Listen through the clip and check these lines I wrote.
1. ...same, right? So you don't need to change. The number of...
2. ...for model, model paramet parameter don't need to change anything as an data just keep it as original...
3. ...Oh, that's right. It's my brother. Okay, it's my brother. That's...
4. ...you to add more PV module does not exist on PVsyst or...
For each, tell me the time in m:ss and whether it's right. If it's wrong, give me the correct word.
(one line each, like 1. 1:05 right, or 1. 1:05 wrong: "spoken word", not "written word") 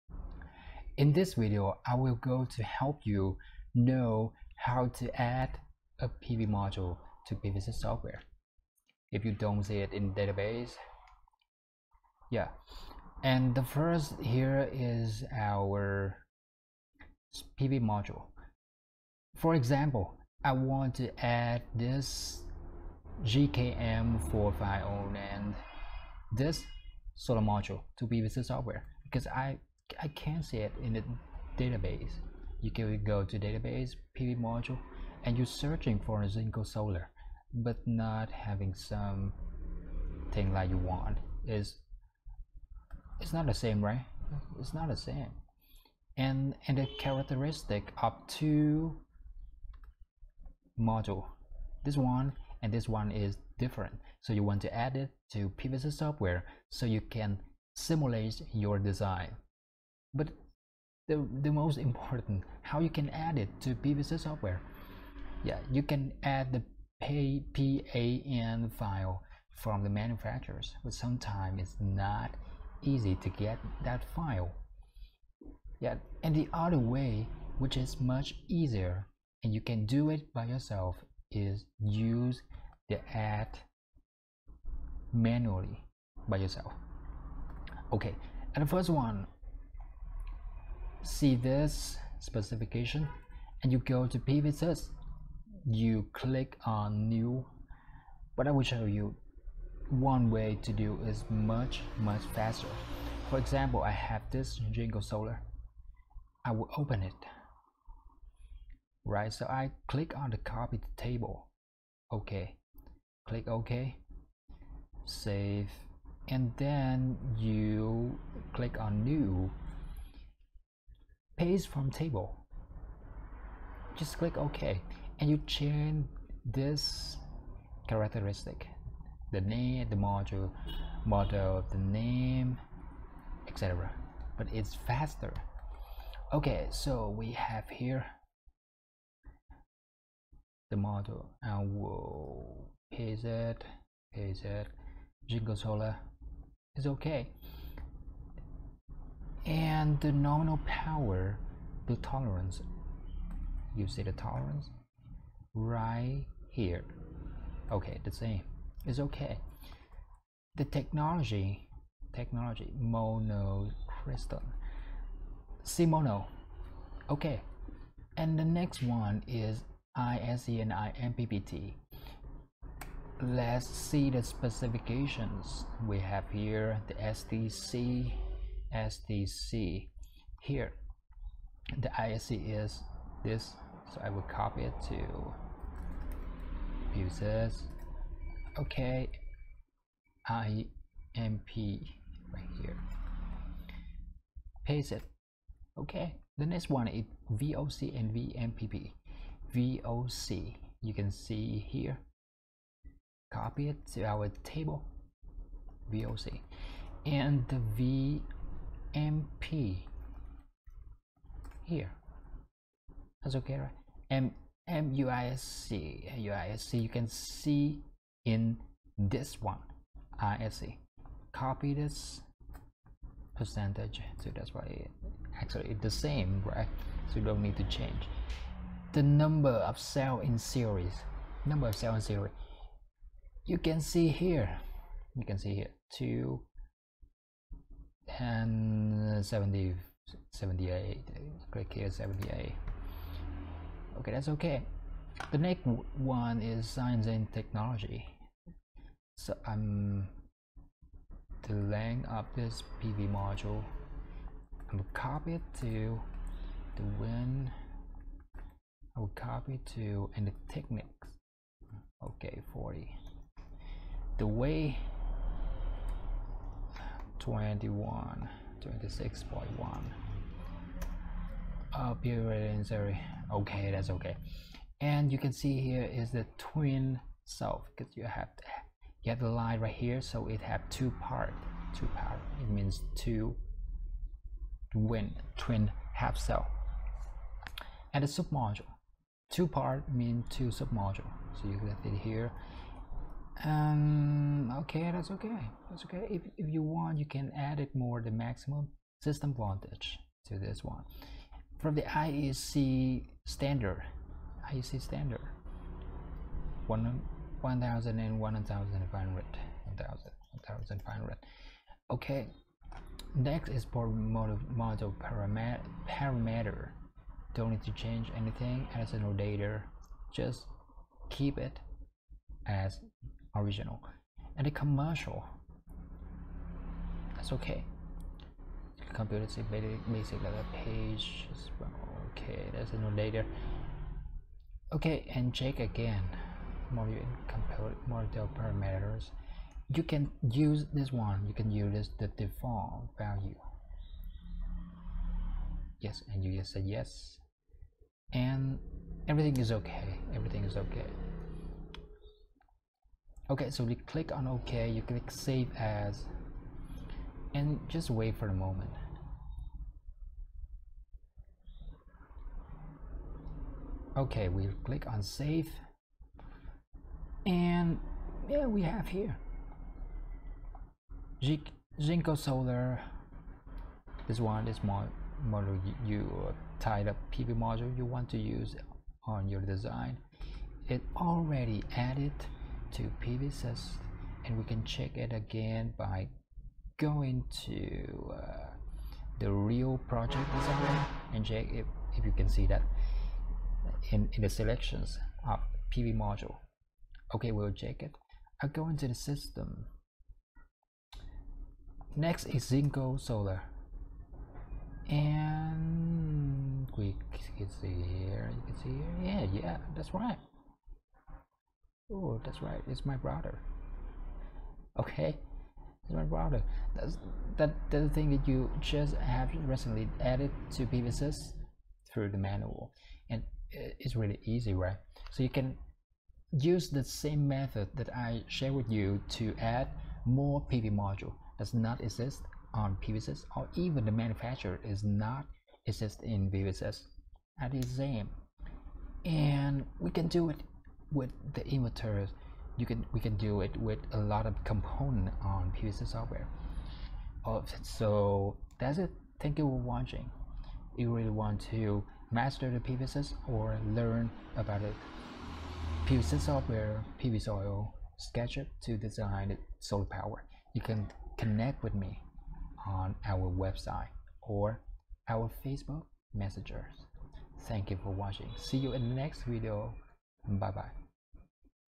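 1. 3:45 right
2. 5:13 right
3. 6:51 right
4. 7:08 right.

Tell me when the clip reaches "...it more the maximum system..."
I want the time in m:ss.
4:57.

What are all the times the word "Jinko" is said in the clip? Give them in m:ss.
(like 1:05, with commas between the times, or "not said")
0:36, 6:11, 6:42.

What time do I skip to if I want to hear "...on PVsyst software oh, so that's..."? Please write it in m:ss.
7:25.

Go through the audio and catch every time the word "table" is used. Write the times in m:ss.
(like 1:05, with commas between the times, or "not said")
1:50, 2:01, 3:24.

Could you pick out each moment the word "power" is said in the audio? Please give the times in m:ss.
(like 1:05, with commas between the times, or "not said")
2:30, 7:39.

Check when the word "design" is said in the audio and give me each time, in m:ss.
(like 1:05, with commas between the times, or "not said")
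0:58, 6:19, 6:30, 7:38.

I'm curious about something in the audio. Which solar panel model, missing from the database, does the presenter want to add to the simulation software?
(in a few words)
JKM450.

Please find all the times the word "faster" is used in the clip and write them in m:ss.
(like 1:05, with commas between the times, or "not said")
1:42, 2:14.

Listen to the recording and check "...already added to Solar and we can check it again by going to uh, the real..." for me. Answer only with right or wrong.
wrong.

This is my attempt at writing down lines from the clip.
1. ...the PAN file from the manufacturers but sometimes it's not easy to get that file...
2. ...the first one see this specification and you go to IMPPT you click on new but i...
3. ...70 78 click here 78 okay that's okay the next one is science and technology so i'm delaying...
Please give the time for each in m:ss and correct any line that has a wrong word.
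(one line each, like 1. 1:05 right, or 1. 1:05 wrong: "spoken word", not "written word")
1. 1:06 right
2. 1:28 wrong: "PVsyst", not "IMPPT"
3. 3:59 right.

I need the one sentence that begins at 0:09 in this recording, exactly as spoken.
If you don't see it in database, yeah.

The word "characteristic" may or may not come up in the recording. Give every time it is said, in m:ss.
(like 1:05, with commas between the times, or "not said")
0:46, 2:07.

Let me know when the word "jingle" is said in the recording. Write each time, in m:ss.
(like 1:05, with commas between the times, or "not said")
1:44, 2:25.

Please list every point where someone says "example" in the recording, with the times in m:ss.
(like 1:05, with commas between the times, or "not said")
0:19, 1:43.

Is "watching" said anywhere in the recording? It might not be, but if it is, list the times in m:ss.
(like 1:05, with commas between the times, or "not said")
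7:29, 7:47.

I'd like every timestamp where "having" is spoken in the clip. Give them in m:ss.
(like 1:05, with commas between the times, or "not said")
0:38.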